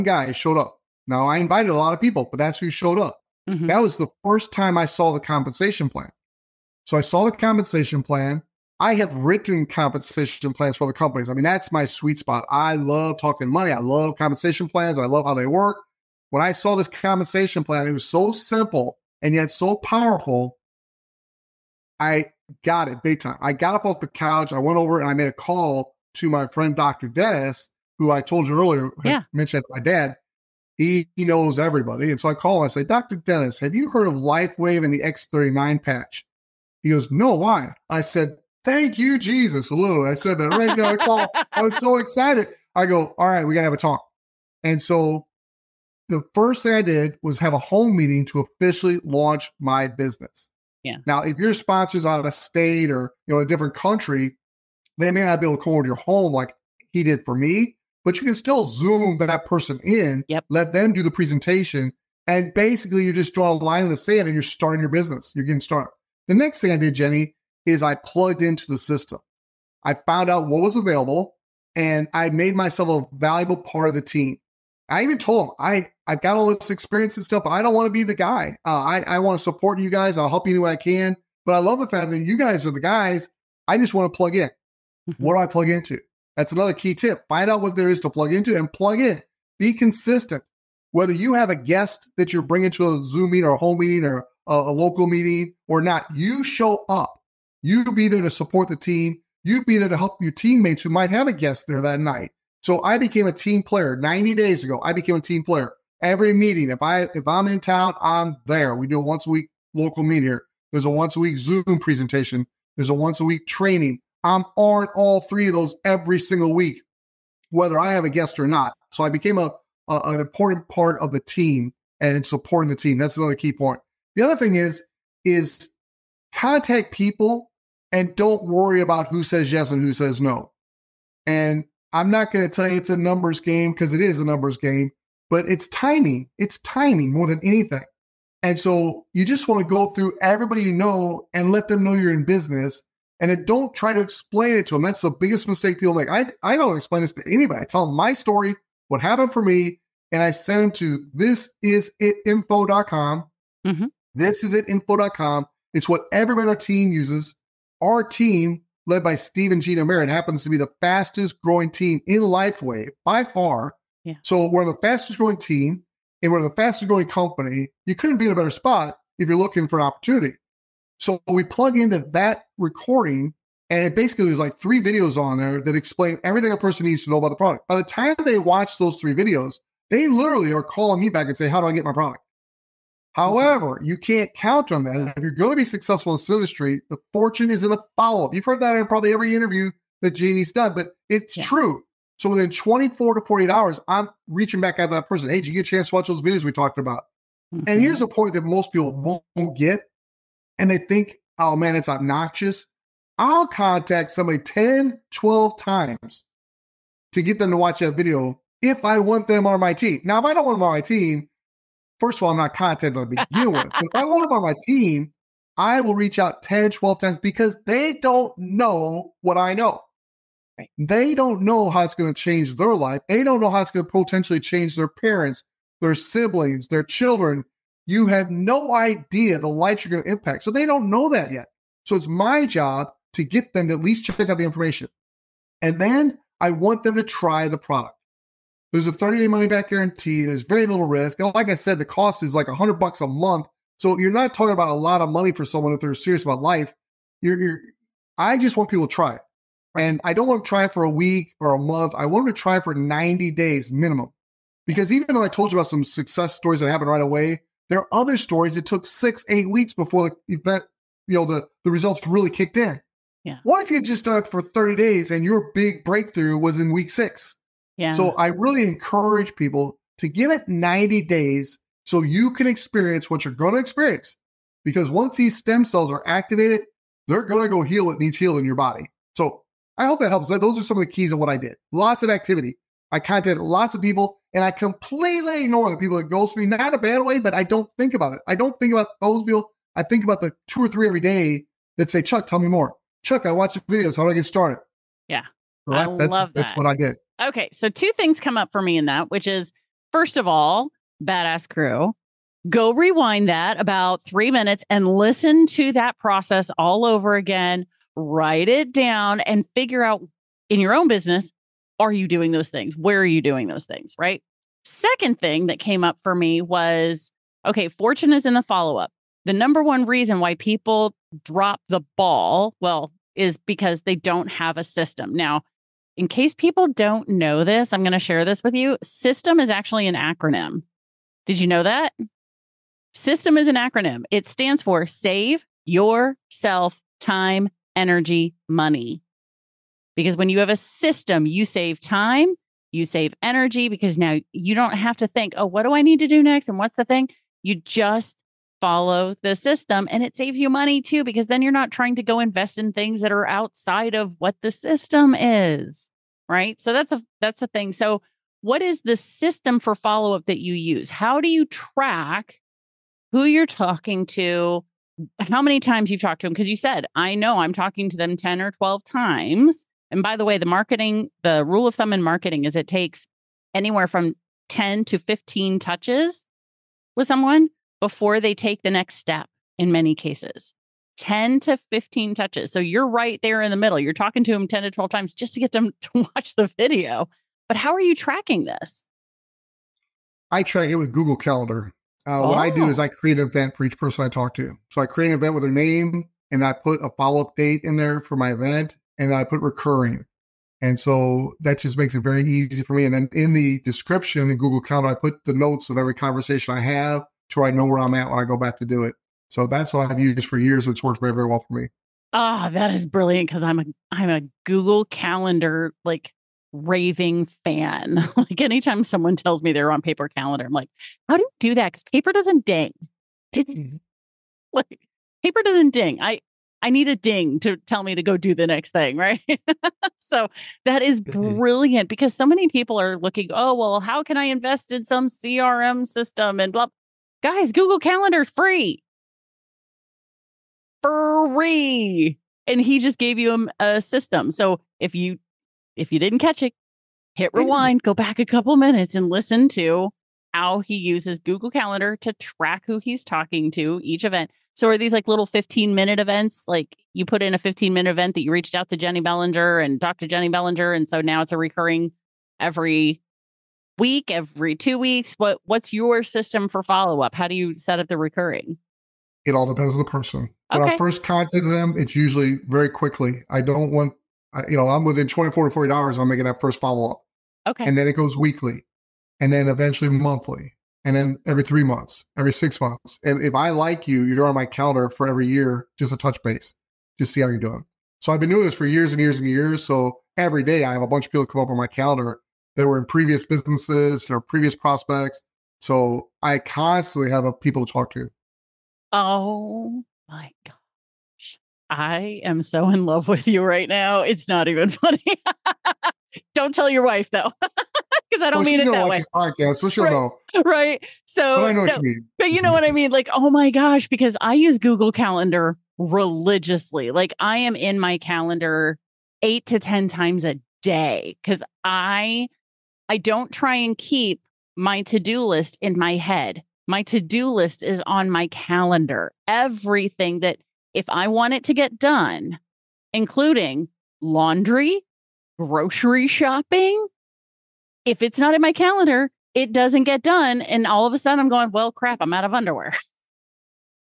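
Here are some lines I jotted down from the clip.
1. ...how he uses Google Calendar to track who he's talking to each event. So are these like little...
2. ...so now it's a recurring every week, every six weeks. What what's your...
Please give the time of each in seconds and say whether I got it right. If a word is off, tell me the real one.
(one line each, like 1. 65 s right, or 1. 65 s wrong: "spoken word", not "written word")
1. 450 s right
2. 460 s wrong: "two", not "six".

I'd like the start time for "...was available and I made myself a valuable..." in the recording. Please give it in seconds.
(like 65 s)
70 s.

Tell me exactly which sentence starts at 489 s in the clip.
So every day I have a bunch of people come up on my calendar that were in previous businesses or previous prospects.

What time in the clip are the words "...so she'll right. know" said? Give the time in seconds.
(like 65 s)
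509 s.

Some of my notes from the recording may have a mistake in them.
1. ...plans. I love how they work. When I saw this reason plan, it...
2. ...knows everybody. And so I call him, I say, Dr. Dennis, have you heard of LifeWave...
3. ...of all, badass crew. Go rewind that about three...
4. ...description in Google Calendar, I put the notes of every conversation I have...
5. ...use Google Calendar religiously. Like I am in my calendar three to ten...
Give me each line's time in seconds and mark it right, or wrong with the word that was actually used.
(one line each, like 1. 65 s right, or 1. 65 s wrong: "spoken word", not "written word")
1. 14 s wrong: "compensation", not "reason"
2. 31 s right
3. 300 s right
4. 403 s right
5. 514 s wrong: "eight", not "three".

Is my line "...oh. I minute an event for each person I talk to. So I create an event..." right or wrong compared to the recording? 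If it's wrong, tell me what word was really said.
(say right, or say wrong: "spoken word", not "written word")
wrong: "create", not "minute".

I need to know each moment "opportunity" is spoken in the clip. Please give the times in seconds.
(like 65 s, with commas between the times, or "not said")
169 s.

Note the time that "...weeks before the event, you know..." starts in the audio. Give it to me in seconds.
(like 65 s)
259 s.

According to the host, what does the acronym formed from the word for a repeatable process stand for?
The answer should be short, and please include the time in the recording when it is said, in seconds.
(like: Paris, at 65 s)
save yourself time, energy, money, at 334 s.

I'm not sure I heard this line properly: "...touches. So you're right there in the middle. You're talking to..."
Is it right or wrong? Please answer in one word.
right.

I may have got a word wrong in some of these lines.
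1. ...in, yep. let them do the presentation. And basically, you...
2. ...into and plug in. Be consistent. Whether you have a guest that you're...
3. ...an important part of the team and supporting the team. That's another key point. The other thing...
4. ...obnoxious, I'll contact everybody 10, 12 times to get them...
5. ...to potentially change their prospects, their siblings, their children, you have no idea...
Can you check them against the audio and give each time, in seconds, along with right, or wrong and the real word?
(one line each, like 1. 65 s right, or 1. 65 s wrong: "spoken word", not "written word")
1. 59 s right
2. 88 s right
3. 120 s right
4. 201 s wrong: "somebody", not "everybody"
5. 223 s wrong: "parents", not "prospects".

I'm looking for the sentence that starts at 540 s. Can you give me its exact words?
And all of a sudden I'm going, well, crap, I'm out of underwear.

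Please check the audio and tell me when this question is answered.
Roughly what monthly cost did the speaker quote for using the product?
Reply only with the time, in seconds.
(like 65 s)
242 s.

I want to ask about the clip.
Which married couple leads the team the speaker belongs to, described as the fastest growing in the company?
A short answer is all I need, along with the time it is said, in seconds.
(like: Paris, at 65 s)
Steve and Gina Merritt, at 159 s.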